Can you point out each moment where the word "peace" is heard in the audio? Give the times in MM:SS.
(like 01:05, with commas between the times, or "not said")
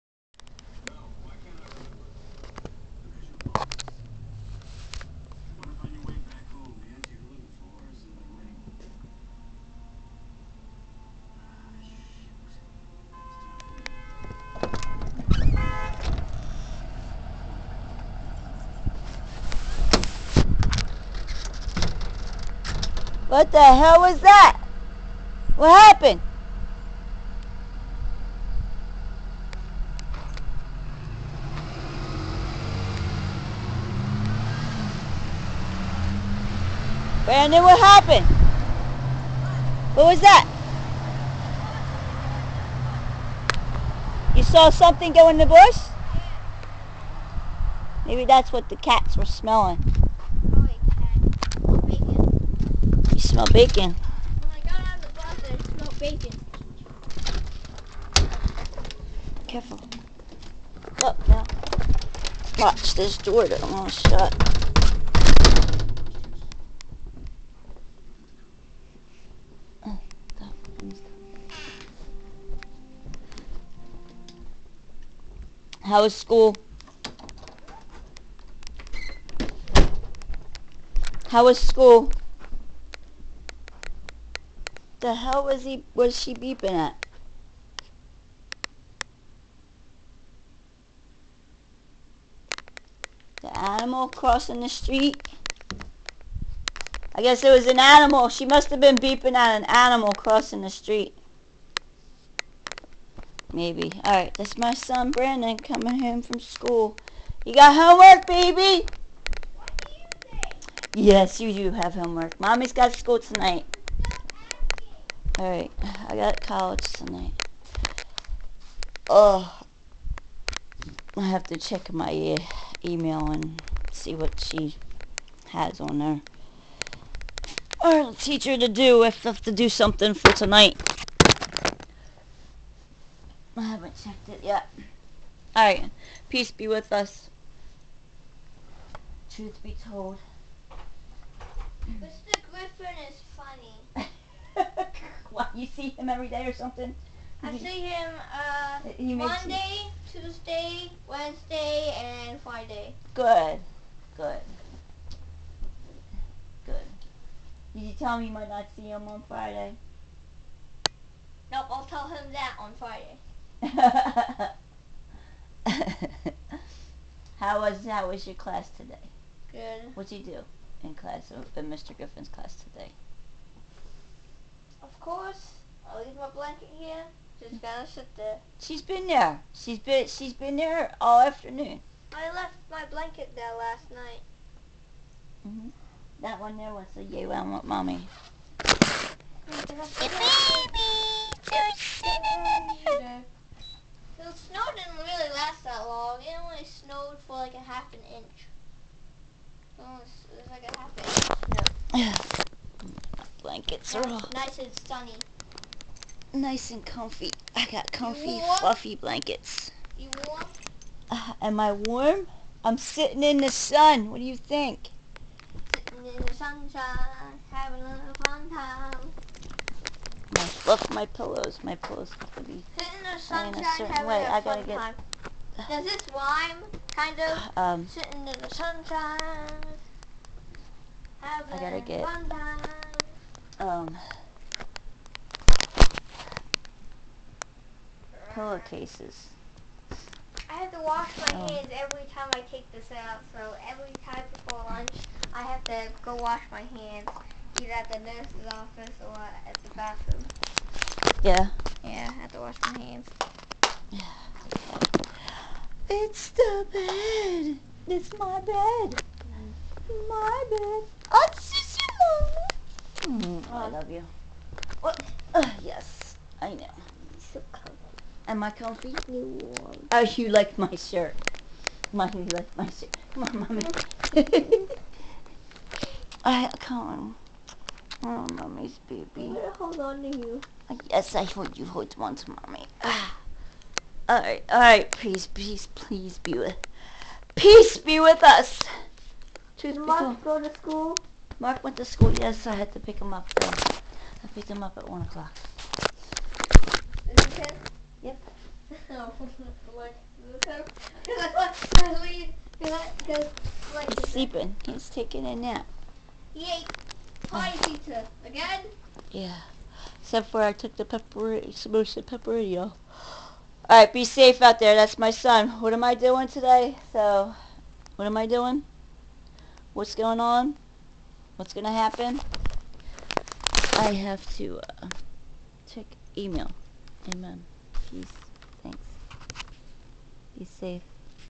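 02:16, 04:47, 05:27.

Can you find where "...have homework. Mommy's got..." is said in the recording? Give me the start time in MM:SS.
01:51.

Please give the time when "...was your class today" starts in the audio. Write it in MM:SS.
02:48.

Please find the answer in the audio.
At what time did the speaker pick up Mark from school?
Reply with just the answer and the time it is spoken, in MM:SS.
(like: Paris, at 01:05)
1 o'clock, at 04:54.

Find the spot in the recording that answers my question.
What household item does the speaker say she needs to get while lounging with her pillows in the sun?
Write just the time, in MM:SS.
03:58.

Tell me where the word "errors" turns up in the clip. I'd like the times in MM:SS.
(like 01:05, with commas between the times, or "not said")
not said.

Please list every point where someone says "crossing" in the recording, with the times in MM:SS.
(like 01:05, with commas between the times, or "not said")
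01:34, 01:40.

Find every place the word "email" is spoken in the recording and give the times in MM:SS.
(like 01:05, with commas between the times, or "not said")
02:02, 05:26.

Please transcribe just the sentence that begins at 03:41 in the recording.
My pillows have to be in the sunshine, in a certain way.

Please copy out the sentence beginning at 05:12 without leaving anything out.
All right, be safe out there.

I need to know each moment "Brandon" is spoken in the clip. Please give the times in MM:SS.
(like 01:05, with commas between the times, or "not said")
00:37, 01:45.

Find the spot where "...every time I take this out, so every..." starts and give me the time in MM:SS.
04:01.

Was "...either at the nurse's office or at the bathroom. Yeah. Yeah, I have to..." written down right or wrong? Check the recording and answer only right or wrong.
right.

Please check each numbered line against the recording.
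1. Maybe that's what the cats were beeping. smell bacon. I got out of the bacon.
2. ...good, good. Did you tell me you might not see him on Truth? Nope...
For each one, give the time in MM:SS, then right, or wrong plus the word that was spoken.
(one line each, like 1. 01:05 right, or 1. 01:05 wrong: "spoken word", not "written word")
1. 00:48 wrong: "smelling", not "beeping"
2. 02:34 wrong: "Friday", not "Truth".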